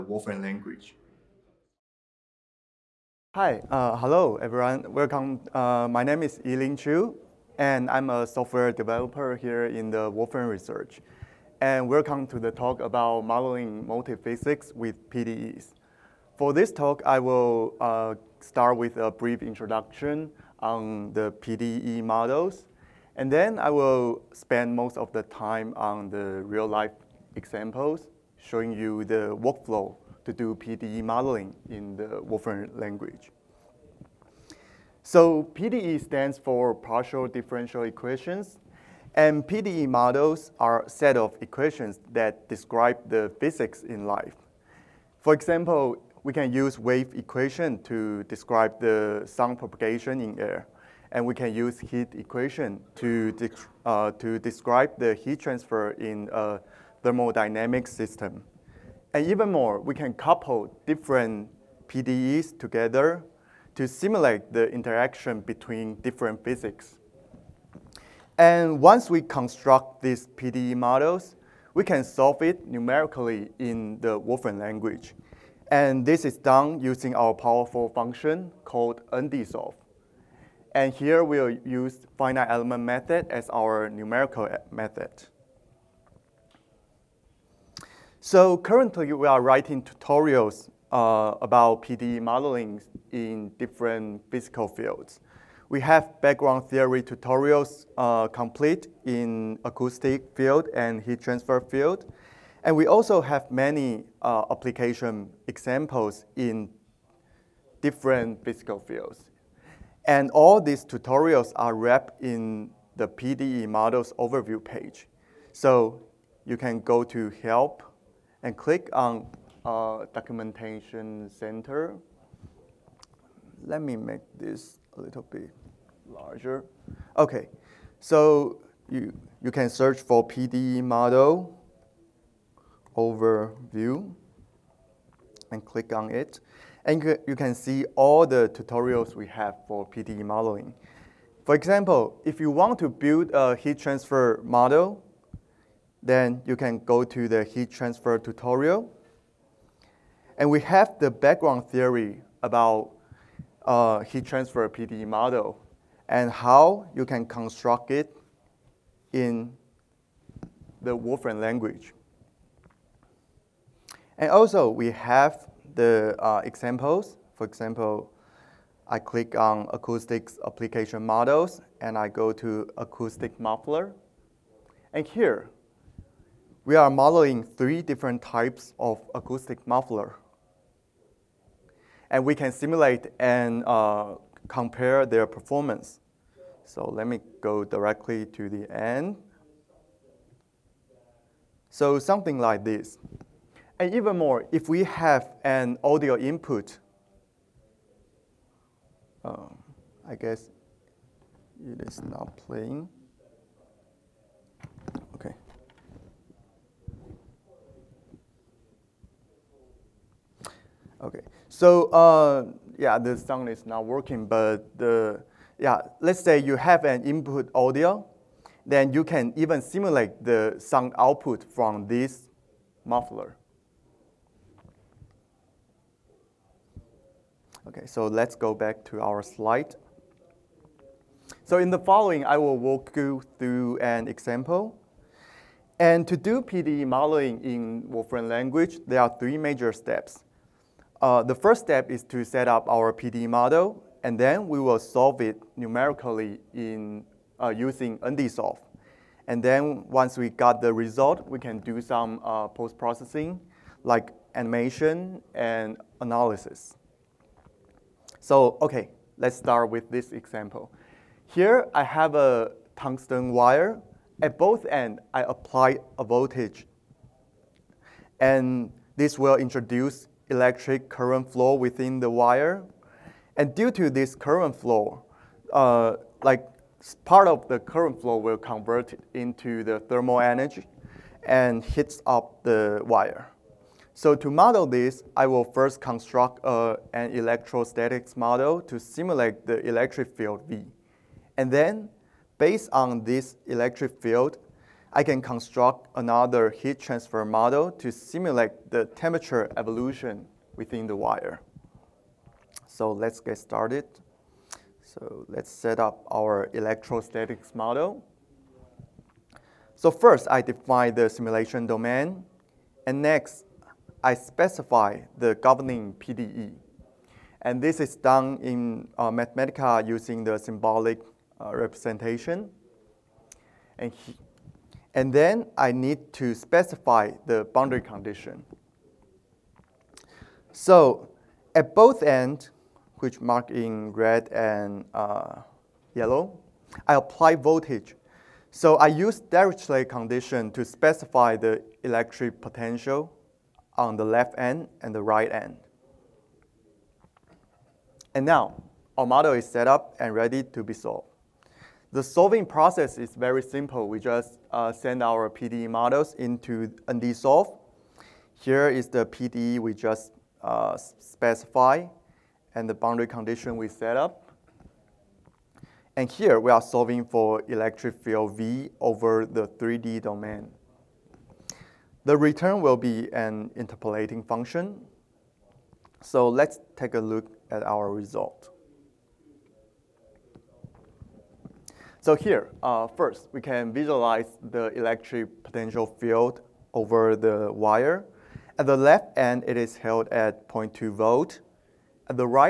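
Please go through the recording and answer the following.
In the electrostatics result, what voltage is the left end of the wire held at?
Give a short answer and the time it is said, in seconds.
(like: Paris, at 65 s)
0.2 volts, at 390 s.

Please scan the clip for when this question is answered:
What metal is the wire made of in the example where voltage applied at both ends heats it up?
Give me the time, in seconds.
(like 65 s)
262 s.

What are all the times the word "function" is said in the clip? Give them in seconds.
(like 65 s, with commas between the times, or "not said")
77 s, 374 s.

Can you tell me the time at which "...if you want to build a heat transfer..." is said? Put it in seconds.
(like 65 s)
142 s.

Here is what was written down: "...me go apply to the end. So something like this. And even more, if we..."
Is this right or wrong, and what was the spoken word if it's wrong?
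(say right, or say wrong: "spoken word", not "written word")
wrong: "directly", not "apply".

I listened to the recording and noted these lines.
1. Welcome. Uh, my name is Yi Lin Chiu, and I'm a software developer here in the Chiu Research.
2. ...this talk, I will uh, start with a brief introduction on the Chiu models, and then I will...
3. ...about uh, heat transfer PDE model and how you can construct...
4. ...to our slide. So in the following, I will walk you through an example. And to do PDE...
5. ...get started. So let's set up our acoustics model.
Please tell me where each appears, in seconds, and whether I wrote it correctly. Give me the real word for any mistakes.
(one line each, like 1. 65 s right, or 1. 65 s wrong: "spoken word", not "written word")
1. 4 s wrong: "Wolfram", not "Chiu"
2. 16 s wrong: "PDE", not "Chiu"
3. 152 s right
4. 228 s right
5. 303 s wrong: "electrostatics", not "acoustics".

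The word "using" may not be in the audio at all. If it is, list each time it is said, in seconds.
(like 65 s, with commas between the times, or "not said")
76 s, 247 s, 319 s.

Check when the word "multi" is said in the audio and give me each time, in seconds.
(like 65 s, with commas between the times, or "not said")
13 s.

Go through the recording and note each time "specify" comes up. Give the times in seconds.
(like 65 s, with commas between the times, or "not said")
314 s, 326 s, 340 s, 360 s.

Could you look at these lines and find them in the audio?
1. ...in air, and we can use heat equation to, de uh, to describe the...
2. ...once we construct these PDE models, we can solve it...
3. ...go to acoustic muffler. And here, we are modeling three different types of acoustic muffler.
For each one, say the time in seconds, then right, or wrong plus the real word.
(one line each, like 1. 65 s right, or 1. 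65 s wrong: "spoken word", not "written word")
1. 50 s right
2. 68 s right
3. 172 s right.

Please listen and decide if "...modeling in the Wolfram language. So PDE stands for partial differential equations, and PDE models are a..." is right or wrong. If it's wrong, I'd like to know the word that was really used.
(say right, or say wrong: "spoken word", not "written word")
right.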